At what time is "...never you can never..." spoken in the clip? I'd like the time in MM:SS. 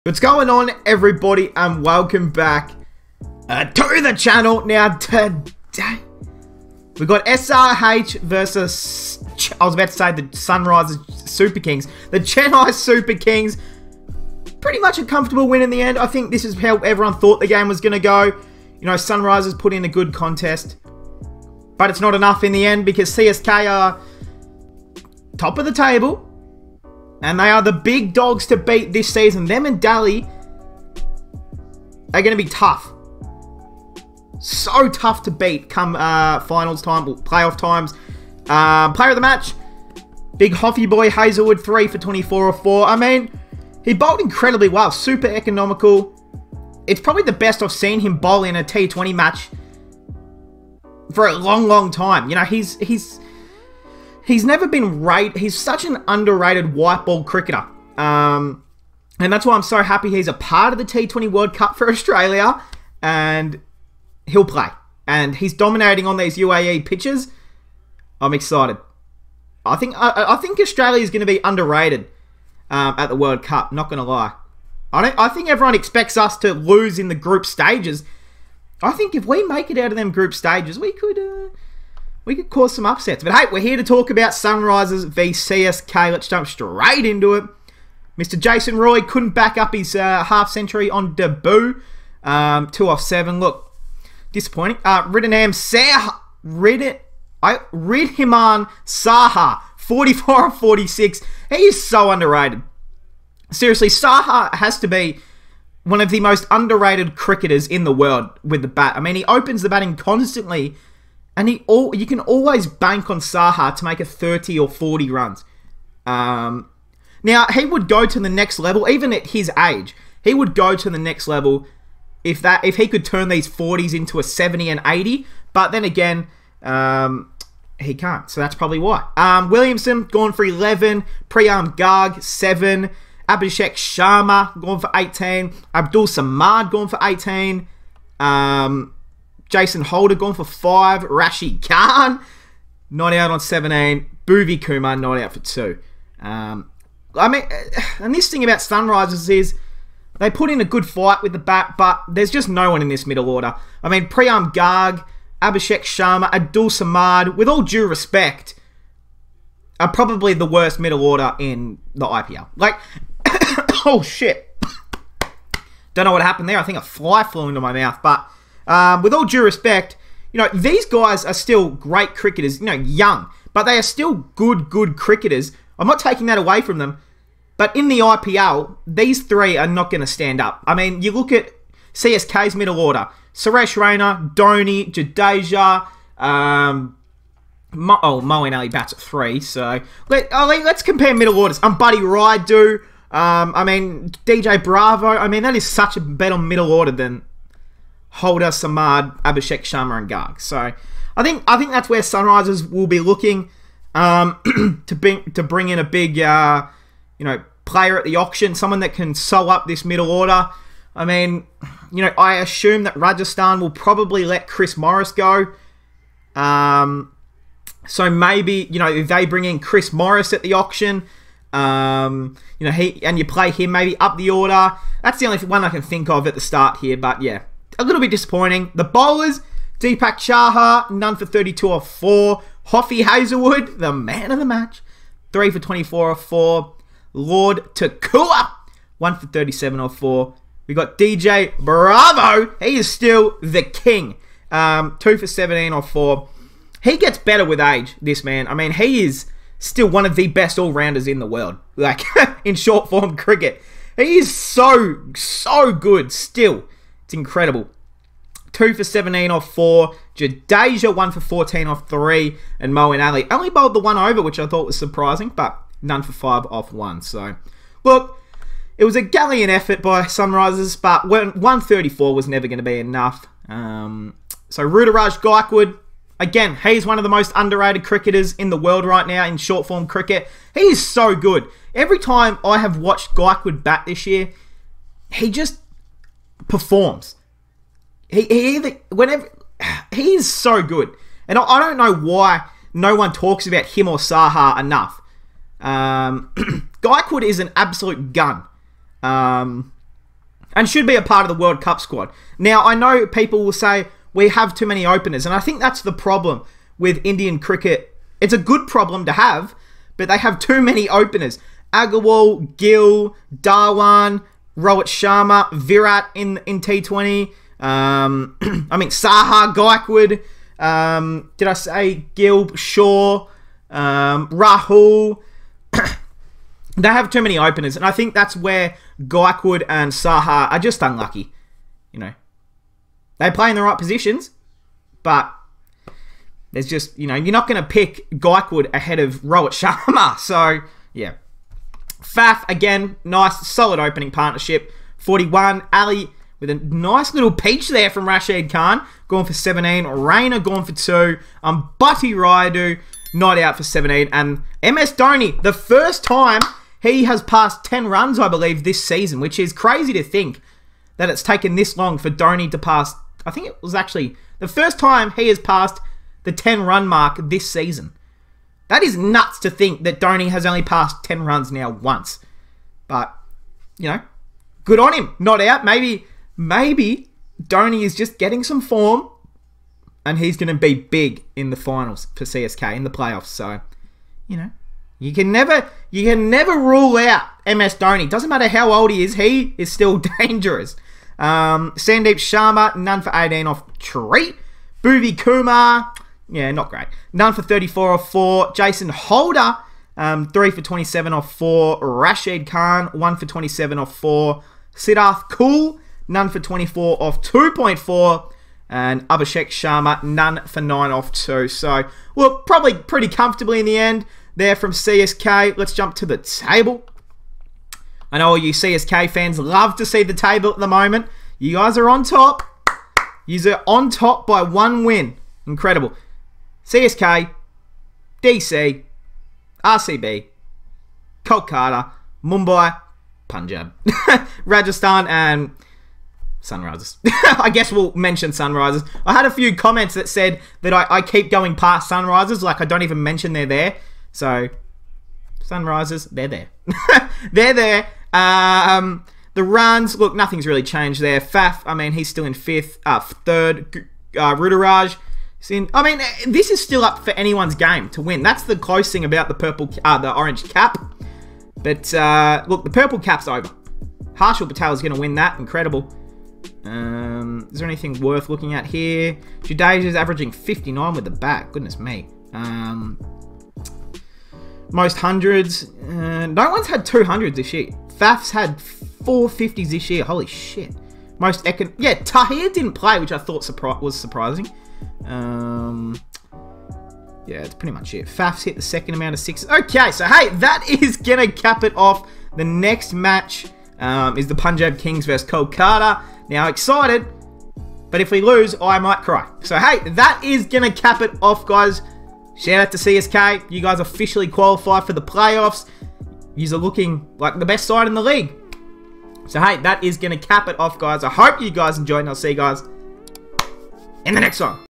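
06:25.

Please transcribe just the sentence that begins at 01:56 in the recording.
Um, now, he would go to the next level, even at his age.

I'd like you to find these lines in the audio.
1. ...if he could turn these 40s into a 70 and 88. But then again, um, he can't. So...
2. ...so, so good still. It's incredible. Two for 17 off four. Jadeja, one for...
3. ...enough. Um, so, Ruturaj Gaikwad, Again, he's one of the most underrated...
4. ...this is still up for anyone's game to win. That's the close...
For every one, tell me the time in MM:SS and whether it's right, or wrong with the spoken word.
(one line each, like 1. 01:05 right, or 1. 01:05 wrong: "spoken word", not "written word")
1. 02:02 wrong: "80", not "88"
2. 04:14 right
3. 04:32 right
4. 07:36 right.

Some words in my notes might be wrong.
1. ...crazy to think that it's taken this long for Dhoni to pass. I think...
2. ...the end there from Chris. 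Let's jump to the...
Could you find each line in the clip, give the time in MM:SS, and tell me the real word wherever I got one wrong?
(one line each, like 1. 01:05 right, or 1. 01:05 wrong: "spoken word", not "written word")
1. 05:59 right
2. 06:53 wrong: "CSK", not "Chris".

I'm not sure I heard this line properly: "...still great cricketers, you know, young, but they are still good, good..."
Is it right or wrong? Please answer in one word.
right.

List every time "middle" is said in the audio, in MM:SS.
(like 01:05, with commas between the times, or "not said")
02:33, 02:40, 03:02, 03:11, 03:16, 03:29.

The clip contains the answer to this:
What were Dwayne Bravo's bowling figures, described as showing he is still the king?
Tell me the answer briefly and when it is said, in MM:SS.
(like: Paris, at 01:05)
2 for 17, at 04:04.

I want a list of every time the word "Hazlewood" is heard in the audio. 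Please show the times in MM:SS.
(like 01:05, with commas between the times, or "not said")
00:41, 03:53.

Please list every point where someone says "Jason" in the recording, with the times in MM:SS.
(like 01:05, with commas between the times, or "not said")
01:28, 02:19, 06:38.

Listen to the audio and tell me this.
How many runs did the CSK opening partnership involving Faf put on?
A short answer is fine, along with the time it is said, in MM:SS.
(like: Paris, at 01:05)
41, at 05:44.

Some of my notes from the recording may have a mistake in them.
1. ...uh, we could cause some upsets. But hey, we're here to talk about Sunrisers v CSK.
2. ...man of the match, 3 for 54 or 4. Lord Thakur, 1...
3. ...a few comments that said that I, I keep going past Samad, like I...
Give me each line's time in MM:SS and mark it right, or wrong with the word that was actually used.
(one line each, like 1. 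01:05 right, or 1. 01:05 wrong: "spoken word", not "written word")
1. 01:21 right
2. 03:53 wrong: "24", not "54"
3. 07:19 wrong: "Sunrisers", not "Samad".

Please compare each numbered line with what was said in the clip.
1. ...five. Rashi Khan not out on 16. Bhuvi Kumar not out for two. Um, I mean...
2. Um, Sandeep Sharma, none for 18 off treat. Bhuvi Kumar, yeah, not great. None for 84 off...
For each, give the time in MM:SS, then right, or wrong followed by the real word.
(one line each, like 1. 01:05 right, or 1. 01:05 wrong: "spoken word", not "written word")
1. 02:20 wrong: "17", not "16"
2. 06:31 wrong: "34", not "84".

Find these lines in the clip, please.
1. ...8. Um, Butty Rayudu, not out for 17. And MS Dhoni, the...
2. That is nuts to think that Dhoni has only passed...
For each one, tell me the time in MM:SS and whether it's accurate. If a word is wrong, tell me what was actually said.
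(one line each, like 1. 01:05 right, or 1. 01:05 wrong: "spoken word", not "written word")
1. 05:50 wrong: "2", not "8"
2. 06:08 right.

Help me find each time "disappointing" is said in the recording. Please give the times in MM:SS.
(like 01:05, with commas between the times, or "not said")
01:34, 03:48.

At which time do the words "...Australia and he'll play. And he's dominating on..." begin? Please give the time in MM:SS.
01:01.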